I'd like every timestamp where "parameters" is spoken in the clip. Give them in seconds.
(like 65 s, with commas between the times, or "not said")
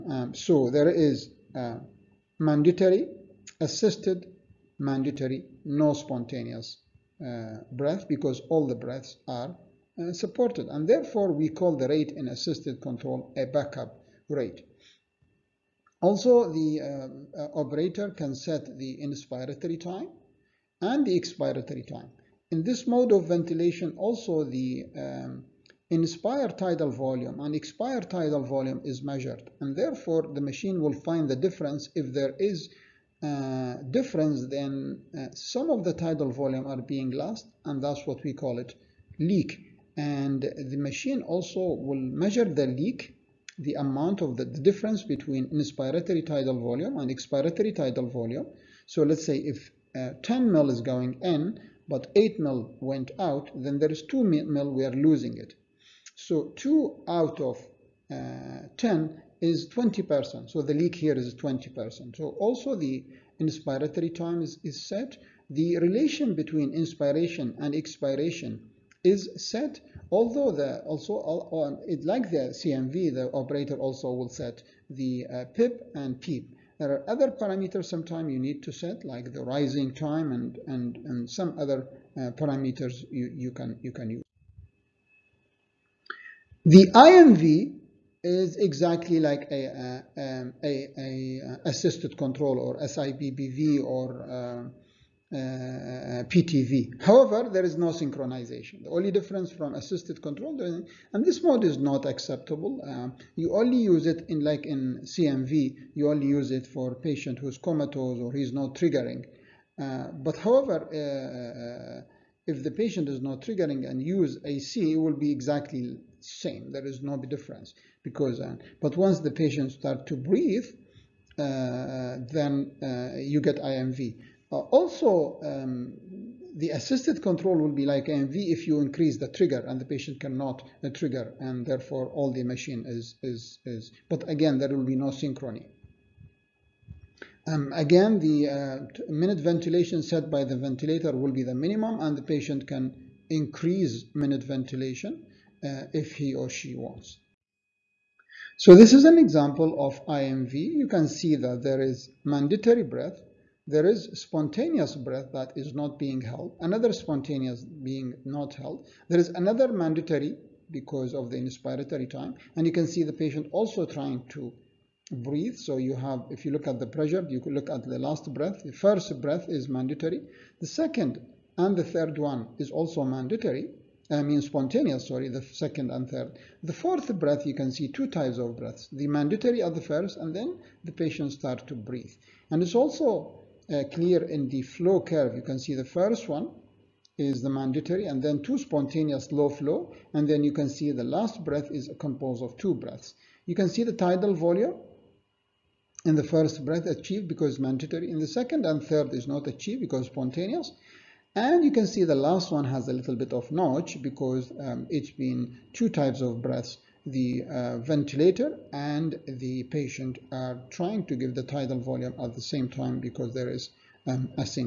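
77 s, 82 s.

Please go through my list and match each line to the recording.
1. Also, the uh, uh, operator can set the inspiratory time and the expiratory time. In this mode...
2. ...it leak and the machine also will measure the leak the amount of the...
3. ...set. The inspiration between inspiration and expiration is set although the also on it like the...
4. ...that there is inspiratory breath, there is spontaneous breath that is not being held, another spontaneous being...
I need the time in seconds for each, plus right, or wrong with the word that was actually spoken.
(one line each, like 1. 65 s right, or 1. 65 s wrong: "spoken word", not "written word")
1. 16 s right
2. 38 s right
3. 64 s wrong: "relation", not "inspiration"
4. 151 s wrong: "mandatory", not "inspiratory".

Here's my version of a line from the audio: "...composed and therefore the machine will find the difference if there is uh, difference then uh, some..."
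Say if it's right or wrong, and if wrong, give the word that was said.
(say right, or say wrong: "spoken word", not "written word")
wrong: "measured", not "composed".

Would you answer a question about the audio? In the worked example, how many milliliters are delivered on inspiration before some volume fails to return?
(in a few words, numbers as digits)
10 mL.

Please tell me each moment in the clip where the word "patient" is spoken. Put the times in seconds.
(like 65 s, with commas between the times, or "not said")
106 s, 112 s, 119 s, 129 s, 142 s, 163 s, 180 s, 209 s.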